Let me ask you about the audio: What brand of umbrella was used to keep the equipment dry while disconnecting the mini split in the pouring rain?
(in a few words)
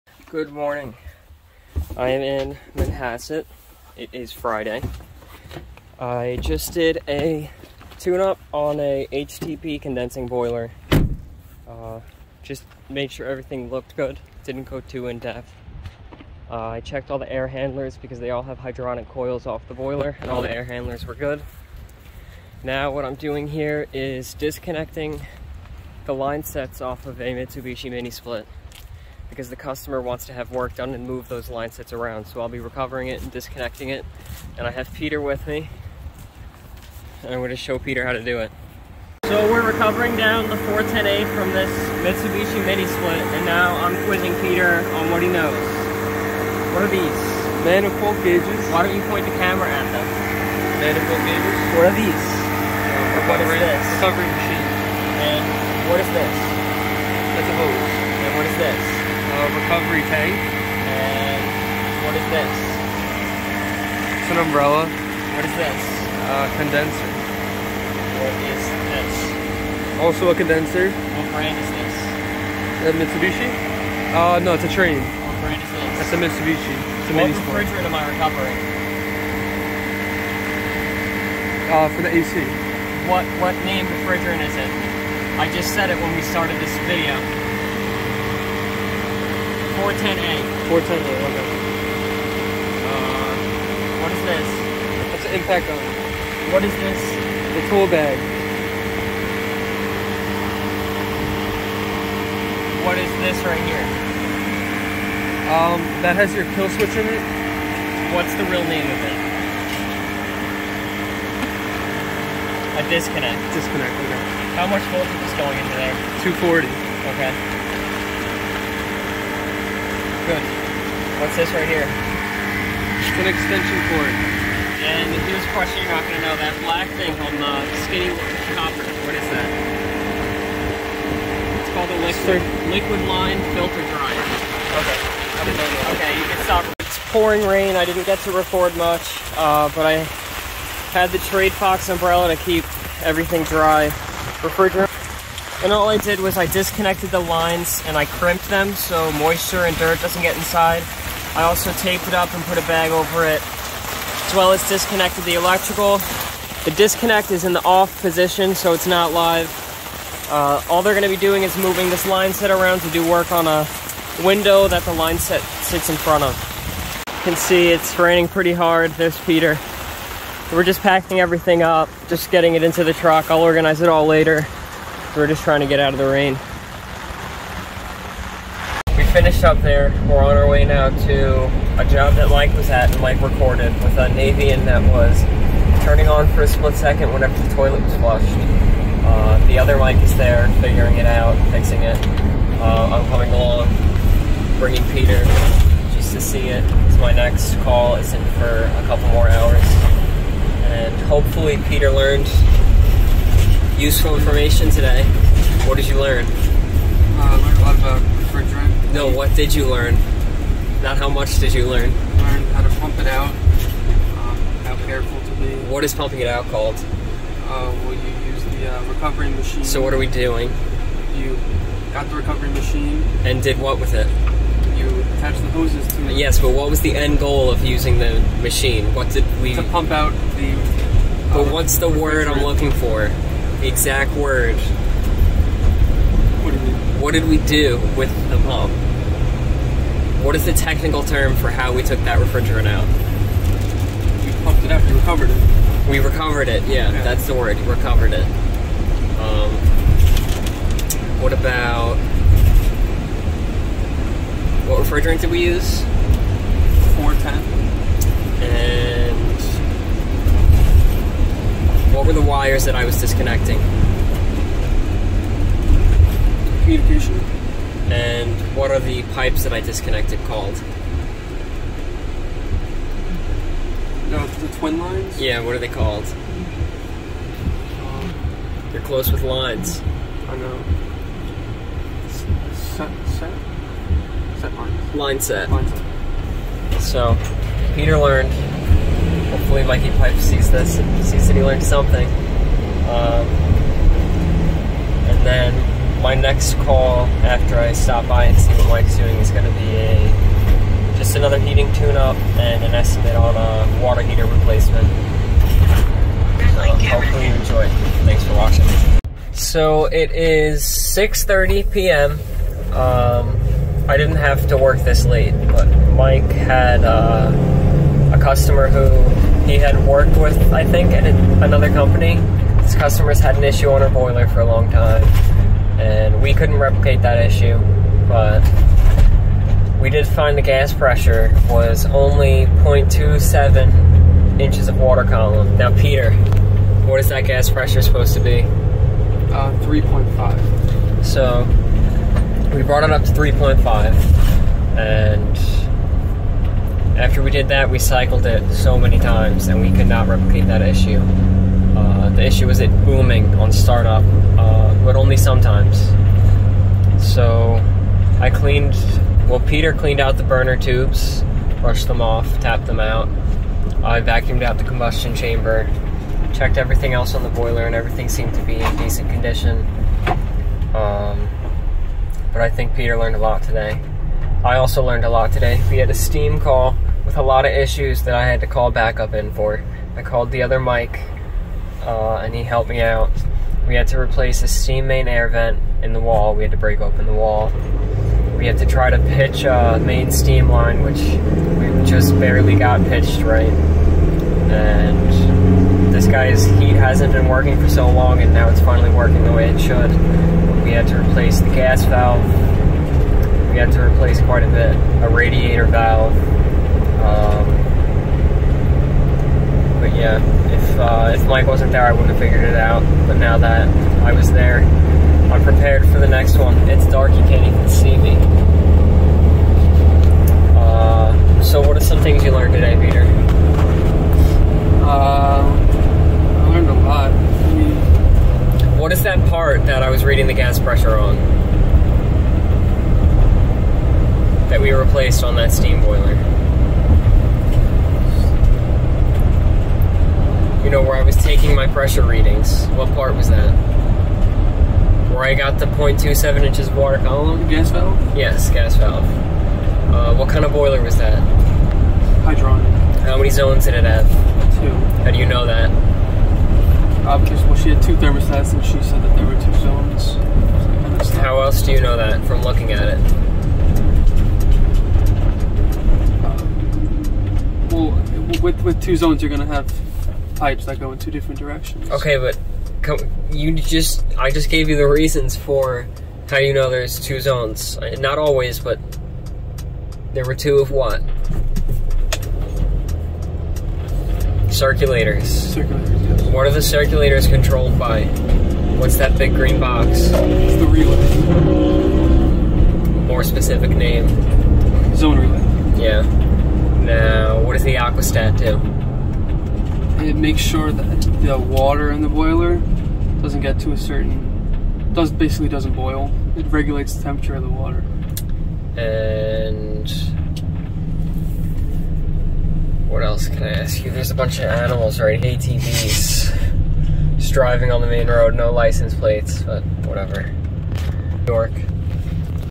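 Trade Fox.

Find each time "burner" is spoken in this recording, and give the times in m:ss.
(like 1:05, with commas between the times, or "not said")
6:00.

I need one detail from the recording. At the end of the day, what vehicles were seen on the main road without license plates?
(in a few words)
ATVs.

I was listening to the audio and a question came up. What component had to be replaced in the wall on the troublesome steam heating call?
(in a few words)
steam main air vent.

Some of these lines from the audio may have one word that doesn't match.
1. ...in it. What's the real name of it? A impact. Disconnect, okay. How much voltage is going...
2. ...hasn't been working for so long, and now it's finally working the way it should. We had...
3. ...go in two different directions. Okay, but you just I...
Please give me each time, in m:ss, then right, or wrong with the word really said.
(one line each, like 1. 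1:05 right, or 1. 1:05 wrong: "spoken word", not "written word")
1. 1:46 wrong: "disconnect", not "impact"
2. 6:36 right
3. 7:50 right.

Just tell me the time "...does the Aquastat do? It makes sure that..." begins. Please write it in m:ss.
8:17.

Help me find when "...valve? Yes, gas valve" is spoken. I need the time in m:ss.
7:27.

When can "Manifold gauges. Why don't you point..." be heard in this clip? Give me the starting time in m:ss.
0:47.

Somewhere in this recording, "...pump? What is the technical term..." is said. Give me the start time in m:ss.
3:58.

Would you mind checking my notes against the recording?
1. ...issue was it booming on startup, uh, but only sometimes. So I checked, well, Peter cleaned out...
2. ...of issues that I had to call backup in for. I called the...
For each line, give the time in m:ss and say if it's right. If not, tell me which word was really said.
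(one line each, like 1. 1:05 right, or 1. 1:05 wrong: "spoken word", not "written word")
1. 5:52 wrong: "cleaned", not "checked"
2. 6:17 right.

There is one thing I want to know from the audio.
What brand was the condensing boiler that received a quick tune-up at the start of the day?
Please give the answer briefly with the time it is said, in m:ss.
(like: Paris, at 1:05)
HTP, at 0:09.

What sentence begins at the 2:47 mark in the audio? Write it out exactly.
You can see it's raining pretty hard.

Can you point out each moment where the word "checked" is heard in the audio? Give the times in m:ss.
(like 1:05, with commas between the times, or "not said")
0:16, 6:06.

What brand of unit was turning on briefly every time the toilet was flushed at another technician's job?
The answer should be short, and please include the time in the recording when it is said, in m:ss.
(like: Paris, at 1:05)
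Navien, at 3:04.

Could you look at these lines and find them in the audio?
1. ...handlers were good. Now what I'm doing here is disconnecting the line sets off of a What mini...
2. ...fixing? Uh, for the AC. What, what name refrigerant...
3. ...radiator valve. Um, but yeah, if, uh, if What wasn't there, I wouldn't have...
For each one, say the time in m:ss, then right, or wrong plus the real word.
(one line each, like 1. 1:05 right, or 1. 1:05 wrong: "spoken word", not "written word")
1. 0:20 wrong: "Mitsubishi", not "What"
2. 1:18 wrong: "recovering", not "fixing"
3. 6:45 wrong: "Mike", not "What".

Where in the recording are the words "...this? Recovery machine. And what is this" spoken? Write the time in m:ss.
0:53.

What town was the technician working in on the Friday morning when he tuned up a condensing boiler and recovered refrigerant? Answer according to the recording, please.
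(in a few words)
Manhasset.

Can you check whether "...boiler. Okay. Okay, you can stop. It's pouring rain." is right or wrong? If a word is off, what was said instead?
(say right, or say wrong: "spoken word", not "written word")
wrong: "dryer", not "boiler".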